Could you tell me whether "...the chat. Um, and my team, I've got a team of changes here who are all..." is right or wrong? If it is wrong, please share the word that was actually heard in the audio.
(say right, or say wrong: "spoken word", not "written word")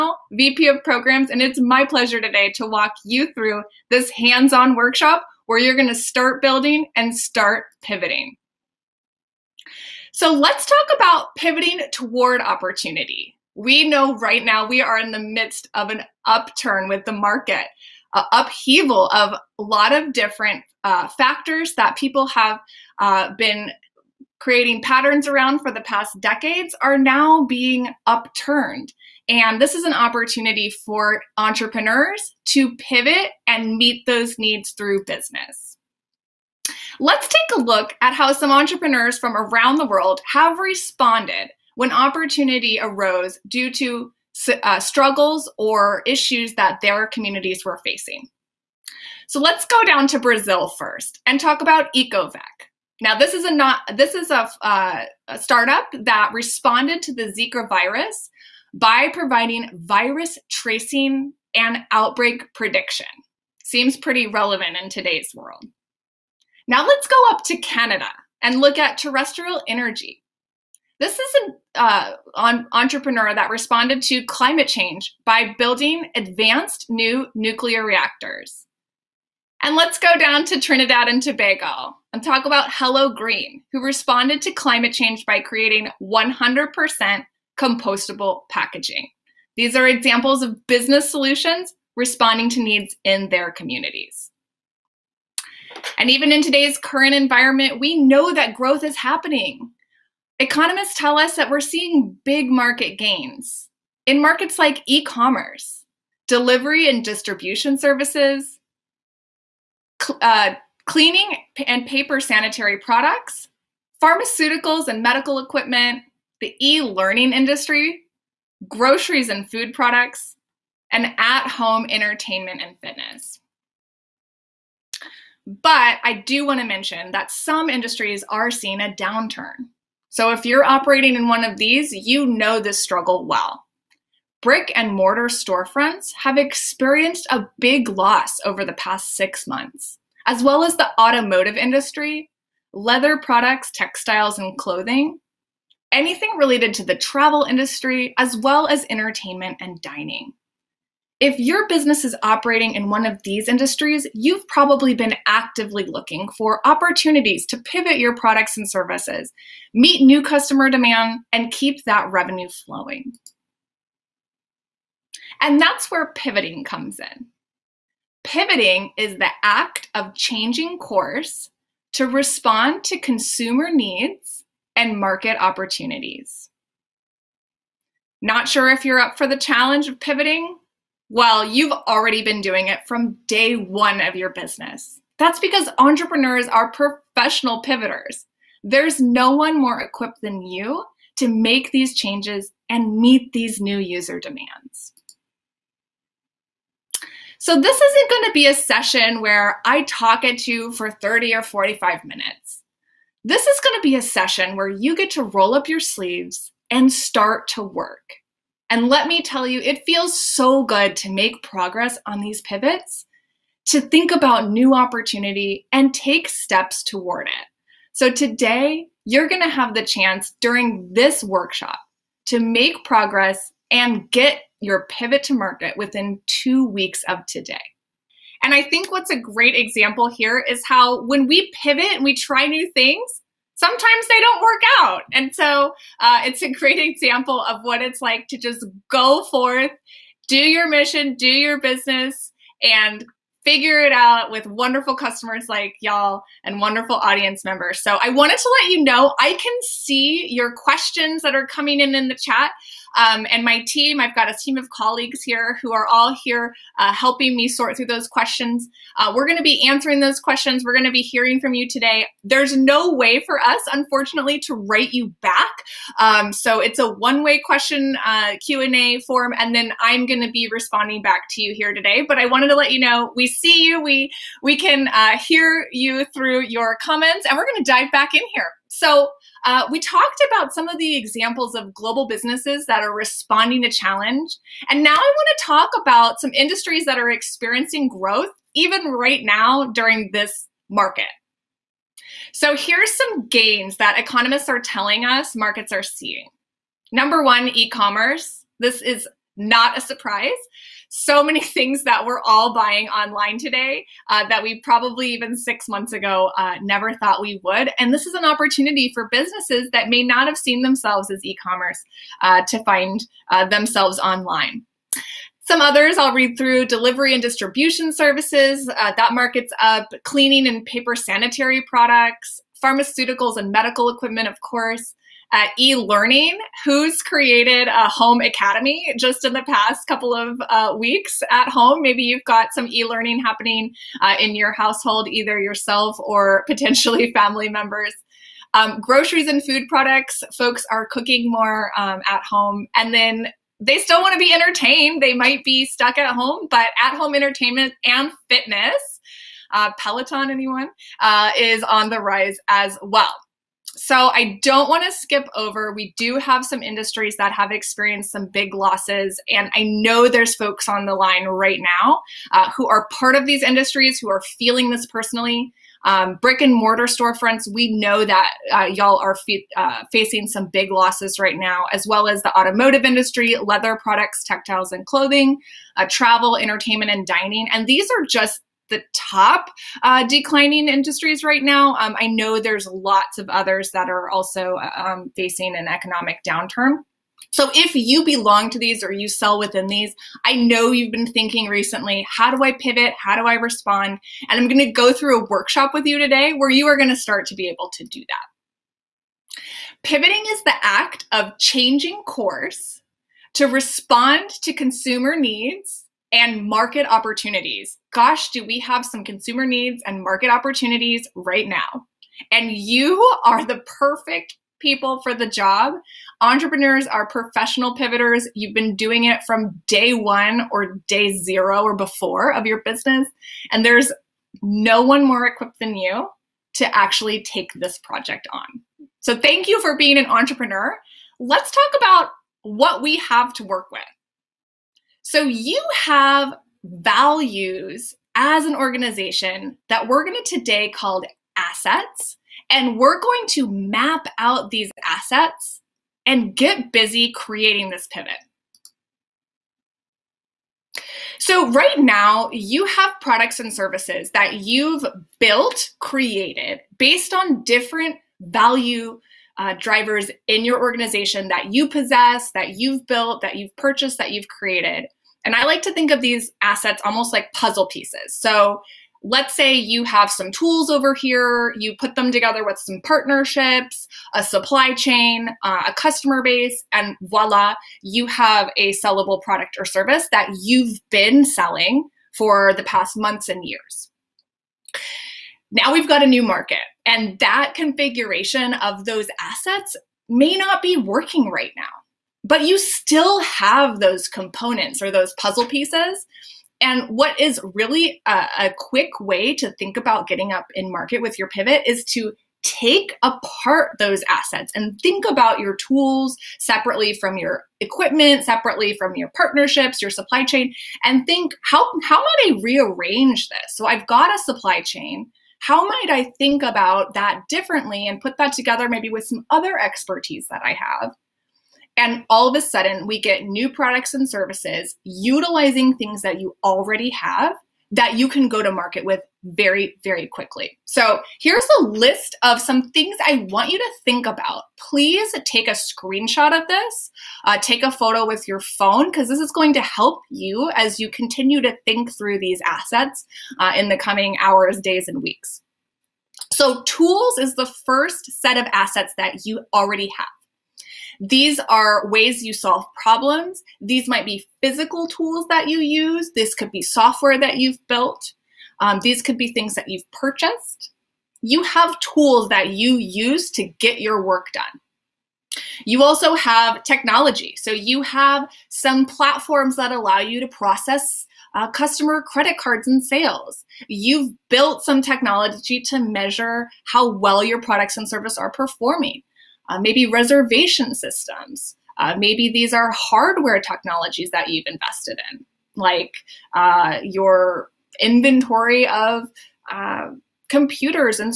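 wrong: "colleagues", not "changes".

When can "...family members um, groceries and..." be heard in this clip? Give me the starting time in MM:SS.
05:37.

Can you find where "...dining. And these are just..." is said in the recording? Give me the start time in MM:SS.
06:17.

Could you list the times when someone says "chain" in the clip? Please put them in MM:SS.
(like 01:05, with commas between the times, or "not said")
07:54, 08:30, 08:34.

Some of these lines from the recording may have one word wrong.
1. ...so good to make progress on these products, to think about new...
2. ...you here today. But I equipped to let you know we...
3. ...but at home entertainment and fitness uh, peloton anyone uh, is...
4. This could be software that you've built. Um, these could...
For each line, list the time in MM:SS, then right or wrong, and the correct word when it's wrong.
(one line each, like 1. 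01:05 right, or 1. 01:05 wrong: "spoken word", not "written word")
1. 03:30 wrong: "pivots", not "products"
2. 04:31 wrong: "wanted", not "equipped"
3. 05:46 right
4. 09:16 right.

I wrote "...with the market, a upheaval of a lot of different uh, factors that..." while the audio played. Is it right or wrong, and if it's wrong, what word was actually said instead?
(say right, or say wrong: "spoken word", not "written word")
right.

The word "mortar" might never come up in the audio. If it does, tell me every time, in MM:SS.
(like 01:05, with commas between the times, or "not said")
02:14, 06:06.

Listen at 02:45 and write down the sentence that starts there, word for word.
And that's where pivoting comes in.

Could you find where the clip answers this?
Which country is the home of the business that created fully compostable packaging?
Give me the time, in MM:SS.
01:20.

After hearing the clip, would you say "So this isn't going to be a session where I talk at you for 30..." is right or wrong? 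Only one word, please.
right.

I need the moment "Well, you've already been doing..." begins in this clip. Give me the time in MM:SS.
03:01.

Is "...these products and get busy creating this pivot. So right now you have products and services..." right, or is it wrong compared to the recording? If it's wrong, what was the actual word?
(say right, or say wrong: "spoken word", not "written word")
wrong: "assets", not "products".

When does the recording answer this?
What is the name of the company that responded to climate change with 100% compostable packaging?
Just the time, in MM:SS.
01:22.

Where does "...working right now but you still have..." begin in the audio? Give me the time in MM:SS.
08:10.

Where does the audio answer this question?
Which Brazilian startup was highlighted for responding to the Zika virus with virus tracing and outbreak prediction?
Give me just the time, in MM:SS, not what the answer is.
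00:51.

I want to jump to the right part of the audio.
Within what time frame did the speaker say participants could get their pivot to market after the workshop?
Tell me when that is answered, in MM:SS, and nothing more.
03:46.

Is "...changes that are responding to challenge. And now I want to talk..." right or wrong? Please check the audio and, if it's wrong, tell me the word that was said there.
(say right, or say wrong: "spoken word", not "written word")
wrong: "businesses", not "changes".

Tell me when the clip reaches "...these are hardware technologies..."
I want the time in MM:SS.
09:42.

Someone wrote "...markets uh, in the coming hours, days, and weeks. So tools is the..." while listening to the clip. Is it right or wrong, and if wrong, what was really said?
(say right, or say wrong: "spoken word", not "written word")
wrong: "assets", not "markets".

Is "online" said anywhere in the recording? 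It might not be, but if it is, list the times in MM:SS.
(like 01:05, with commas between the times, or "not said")
05:02, 05:13.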